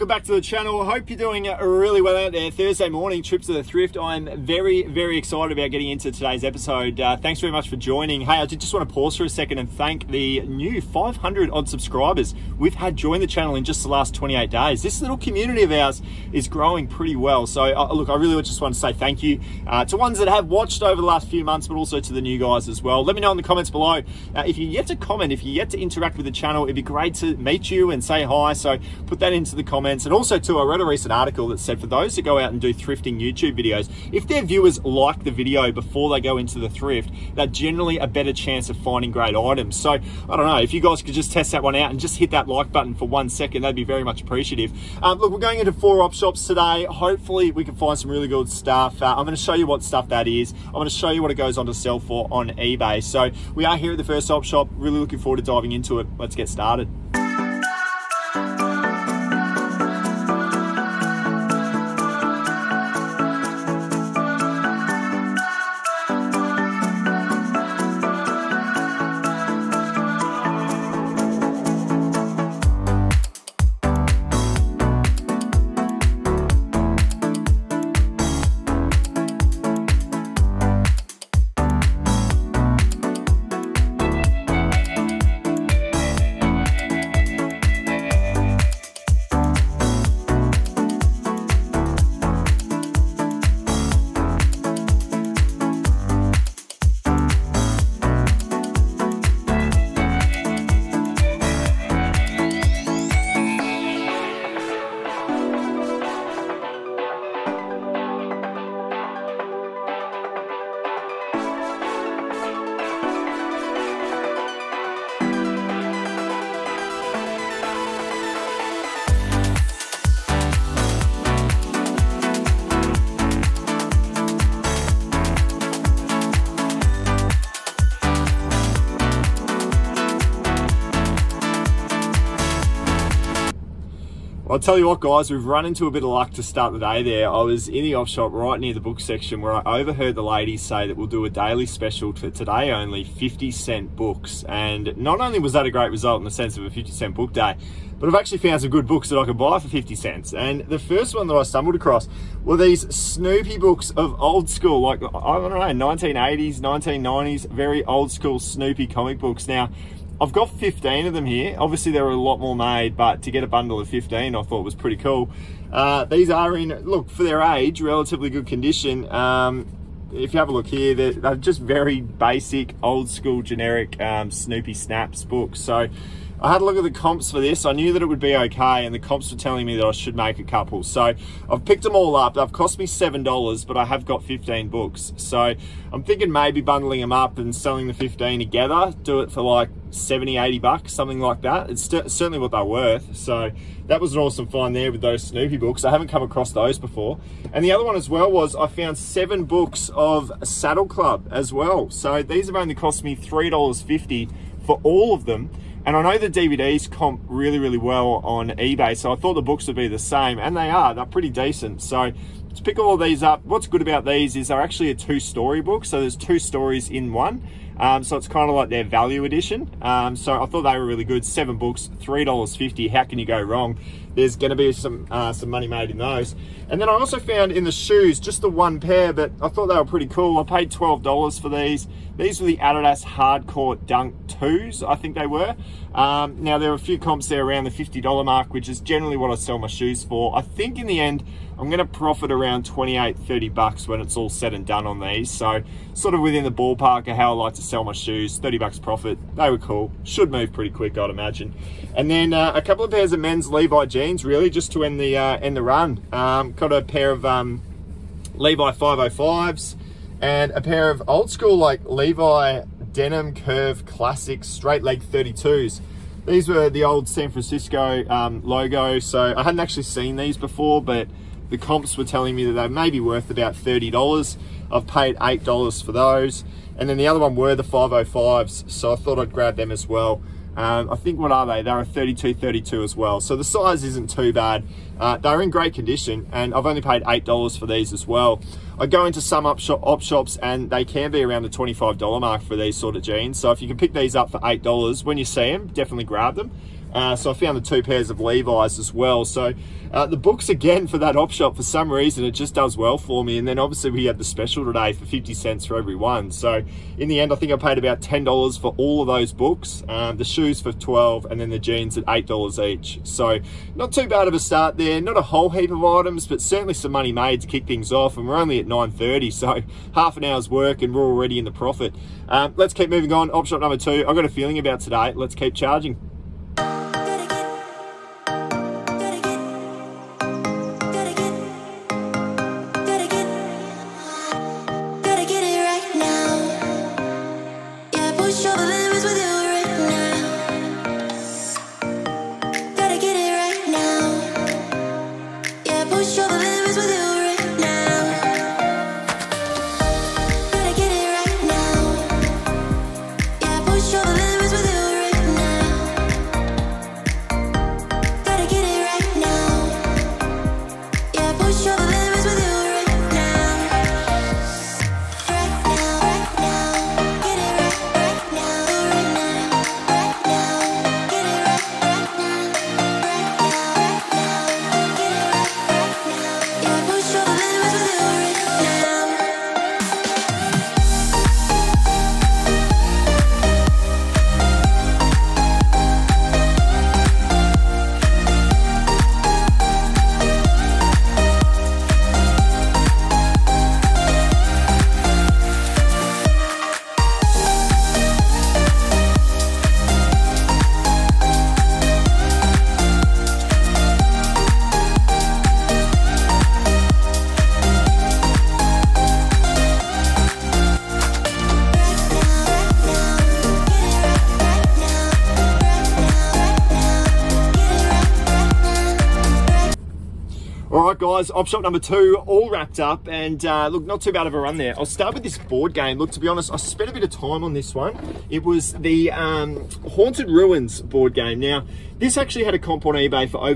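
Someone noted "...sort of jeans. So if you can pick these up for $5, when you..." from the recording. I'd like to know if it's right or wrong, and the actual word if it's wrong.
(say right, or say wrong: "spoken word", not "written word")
wrong: "8", not "5".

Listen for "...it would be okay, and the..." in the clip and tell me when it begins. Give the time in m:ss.
2:58.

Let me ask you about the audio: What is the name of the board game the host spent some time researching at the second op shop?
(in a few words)
Haunted Ruins.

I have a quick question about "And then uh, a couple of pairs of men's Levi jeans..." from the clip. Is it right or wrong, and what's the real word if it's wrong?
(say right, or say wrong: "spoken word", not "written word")
right.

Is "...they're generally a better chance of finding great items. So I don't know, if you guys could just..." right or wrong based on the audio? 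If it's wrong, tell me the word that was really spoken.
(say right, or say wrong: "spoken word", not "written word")
right.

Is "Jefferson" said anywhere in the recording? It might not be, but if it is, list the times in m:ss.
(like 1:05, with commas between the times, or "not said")
not said.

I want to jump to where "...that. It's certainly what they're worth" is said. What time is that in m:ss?
3:11.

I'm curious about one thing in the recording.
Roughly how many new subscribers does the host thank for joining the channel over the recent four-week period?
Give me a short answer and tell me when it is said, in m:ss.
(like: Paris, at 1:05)
500, at 0:10.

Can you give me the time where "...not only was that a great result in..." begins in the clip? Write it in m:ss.
2:24.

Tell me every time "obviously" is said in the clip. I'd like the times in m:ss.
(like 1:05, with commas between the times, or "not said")
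2:41, 5:03.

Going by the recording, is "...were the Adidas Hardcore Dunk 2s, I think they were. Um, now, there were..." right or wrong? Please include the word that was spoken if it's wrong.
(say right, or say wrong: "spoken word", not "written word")
right.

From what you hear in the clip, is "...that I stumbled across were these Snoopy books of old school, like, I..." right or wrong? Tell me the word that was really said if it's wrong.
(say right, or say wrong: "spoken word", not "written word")
right.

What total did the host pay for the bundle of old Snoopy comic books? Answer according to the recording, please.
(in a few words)
$7.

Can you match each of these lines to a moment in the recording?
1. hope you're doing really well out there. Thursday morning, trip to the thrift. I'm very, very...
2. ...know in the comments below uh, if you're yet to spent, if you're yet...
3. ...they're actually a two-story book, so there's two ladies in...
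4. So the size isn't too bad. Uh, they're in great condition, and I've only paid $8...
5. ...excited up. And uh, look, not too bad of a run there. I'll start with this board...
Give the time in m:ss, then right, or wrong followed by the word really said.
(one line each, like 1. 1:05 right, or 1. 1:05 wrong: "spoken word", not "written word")
1. 0:00 right
2. 0:23 wrong: "comment", not "spent"
3. 3:34 wrong: "stories", not "ladies"
4. 4:43 right
5. 7:02 wrong: "wrapped", not "excited".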